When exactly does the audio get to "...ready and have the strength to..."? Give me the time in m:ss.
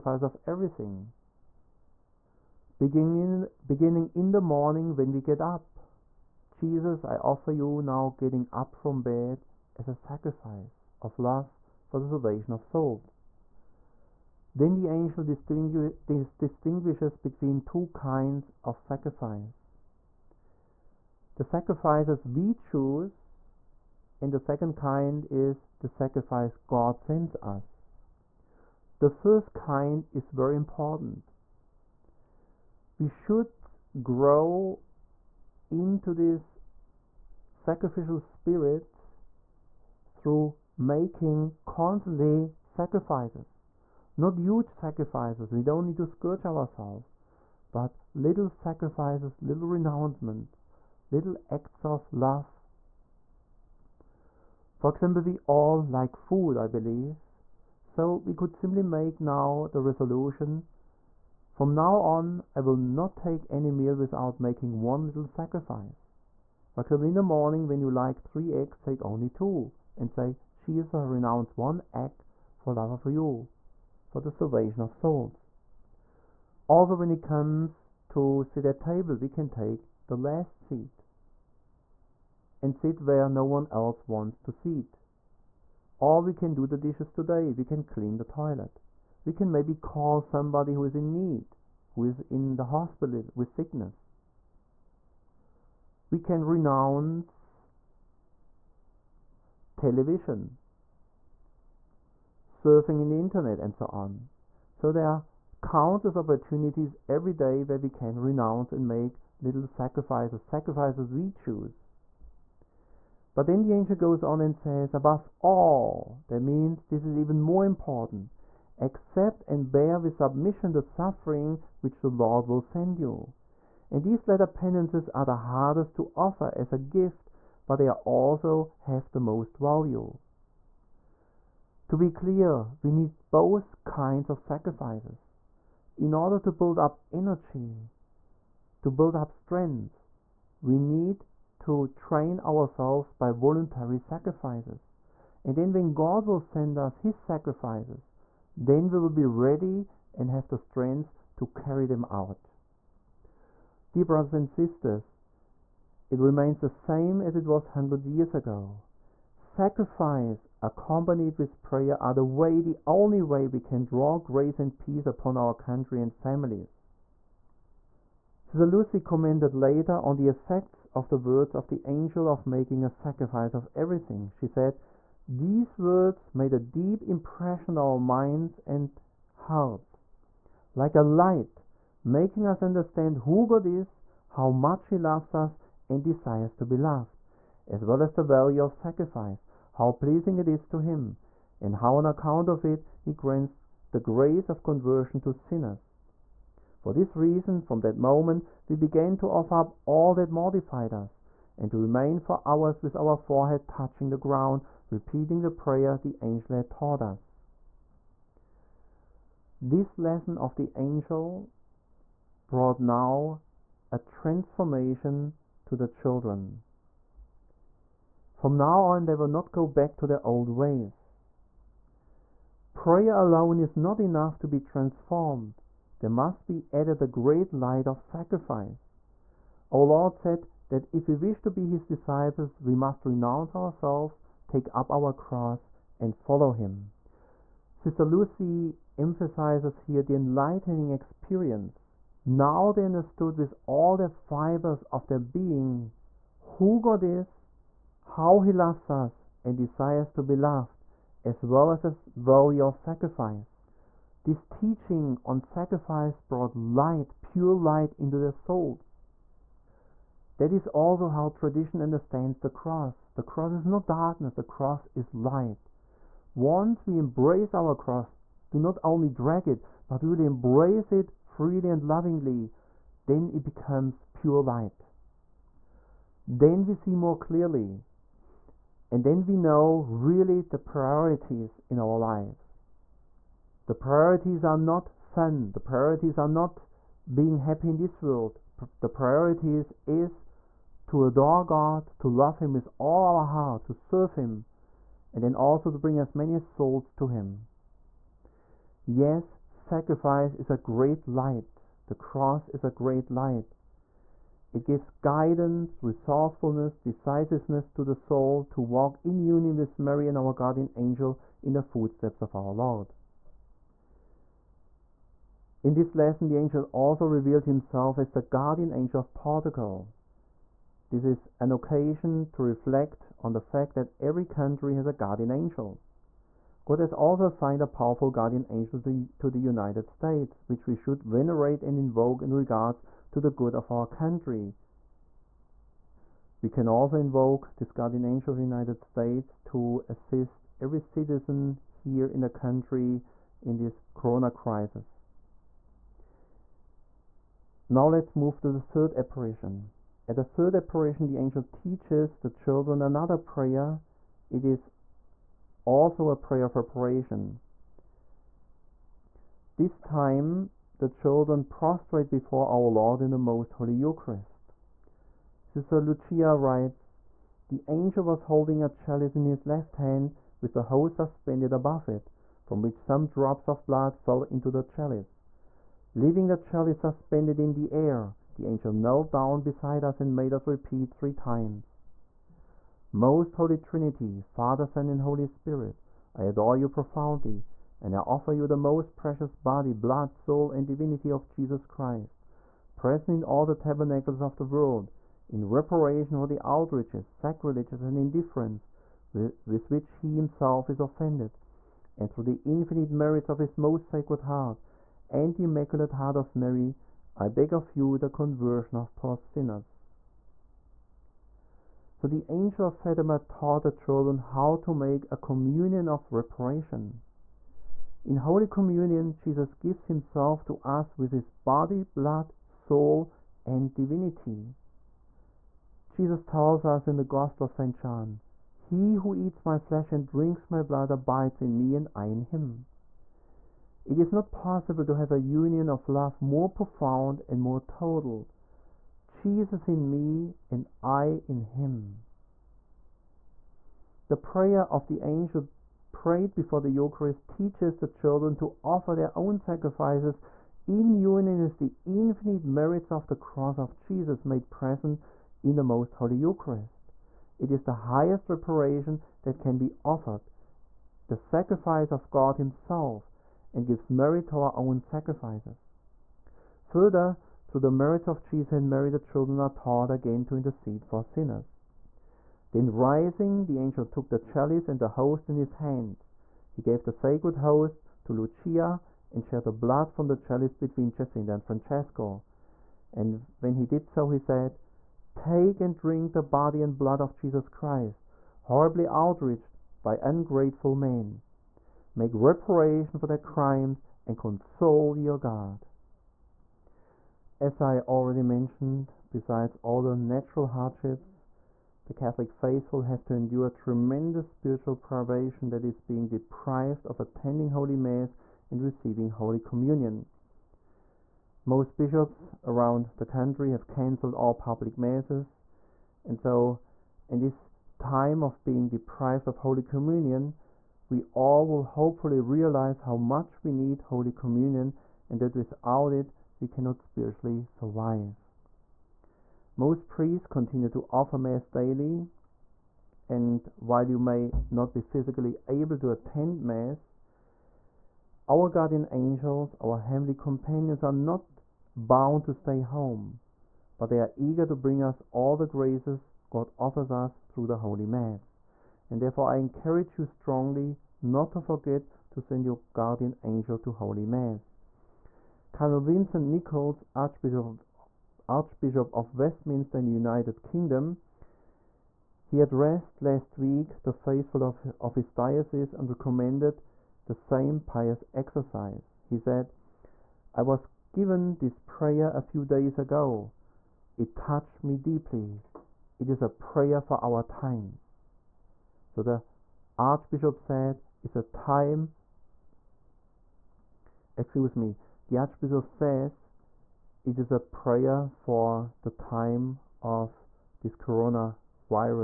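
2:29.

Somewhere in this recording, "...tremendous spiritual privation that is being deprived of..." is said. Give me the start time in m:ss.
8:23.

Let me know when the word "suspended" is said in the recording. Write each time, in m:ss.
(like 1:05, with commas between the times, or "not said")
6:10, 6:16.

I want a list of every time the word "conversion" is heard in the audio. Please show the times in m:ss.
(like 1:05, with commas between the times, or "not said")
3:14, 6:48.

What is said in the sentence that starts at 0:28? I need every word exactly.
The first kind is very important.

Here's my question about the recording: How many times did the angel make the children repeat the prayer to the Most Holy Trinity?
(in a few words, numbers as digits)
3.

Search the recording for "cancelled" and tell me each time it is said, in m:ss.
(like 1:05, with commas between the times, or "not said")
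8:33.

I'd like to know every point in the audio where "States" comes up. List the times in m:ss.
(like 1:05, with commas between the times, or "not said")
5:29, 5:38.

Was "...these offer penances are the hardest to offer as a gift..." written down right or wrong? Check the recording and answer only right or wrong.
wrong.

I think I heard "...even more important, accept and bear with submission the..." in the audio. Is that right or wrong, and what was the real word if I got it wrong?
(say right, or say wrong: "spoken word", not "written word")
right.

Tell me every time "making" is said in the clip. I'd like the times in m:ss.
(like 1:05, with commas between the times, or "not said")
0:40, 1:04, 2:52, 3:02.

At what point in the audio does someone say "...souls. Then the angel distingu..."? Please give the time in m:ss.
0:12.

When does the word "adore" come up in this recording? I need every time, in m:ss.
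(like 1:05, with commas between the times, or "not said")
4:51, 6:26.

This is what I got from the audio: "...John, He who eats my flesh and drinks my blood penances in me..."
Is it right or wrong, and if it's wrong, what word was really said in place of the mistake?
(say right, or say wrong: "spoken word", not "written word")
wrong: "abides", not "penances".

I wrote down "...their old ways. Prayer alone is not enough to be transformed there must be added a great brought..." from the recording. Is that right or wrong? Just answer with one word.
wrong.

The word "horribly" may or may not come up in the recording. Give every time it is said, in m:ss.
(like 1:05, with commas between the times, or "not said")
8:08.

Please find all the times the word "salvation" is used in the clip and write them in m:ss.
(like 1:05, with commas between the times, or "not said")
0:12, 1:14.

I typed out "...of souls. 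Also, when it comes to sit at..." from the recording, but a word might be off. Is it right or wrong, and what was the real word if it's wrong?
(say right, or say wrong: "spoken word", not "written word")
right.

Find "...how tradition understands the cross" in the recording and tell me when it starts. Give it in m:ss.
4:21.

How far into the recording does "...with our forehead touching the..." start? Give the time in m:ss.
3:22.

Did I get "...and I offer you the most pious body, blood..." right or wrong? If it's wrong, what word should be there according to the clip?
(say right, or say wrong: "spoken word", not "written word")
wrong: "precious", not "pious".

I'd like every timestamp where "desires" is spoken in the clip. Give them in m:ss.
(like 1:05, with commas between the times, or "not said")
3:06, 4:09.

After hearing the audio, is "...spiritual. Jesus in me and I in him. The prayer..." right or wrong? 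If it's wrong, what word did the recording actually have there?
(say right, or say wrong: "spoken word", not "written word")
wrong: "total", not "spiritual".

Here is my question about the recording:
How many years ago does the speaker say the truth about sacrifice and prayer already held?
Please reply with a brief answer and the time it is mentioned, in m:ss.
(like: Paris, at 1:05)
100, at 2:37.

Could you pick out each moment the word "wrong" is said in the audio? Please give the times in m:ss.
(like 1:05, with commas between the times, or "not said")
not said.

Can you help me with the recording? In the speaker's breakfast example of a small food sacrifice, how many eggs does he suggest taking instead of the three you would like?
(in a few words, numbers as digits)
2.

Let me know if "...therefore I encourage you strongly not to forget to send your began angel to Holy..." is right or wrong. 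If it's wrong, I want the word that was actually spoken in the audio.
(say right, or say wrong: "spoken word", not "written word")
wrong: "guardian", not "began".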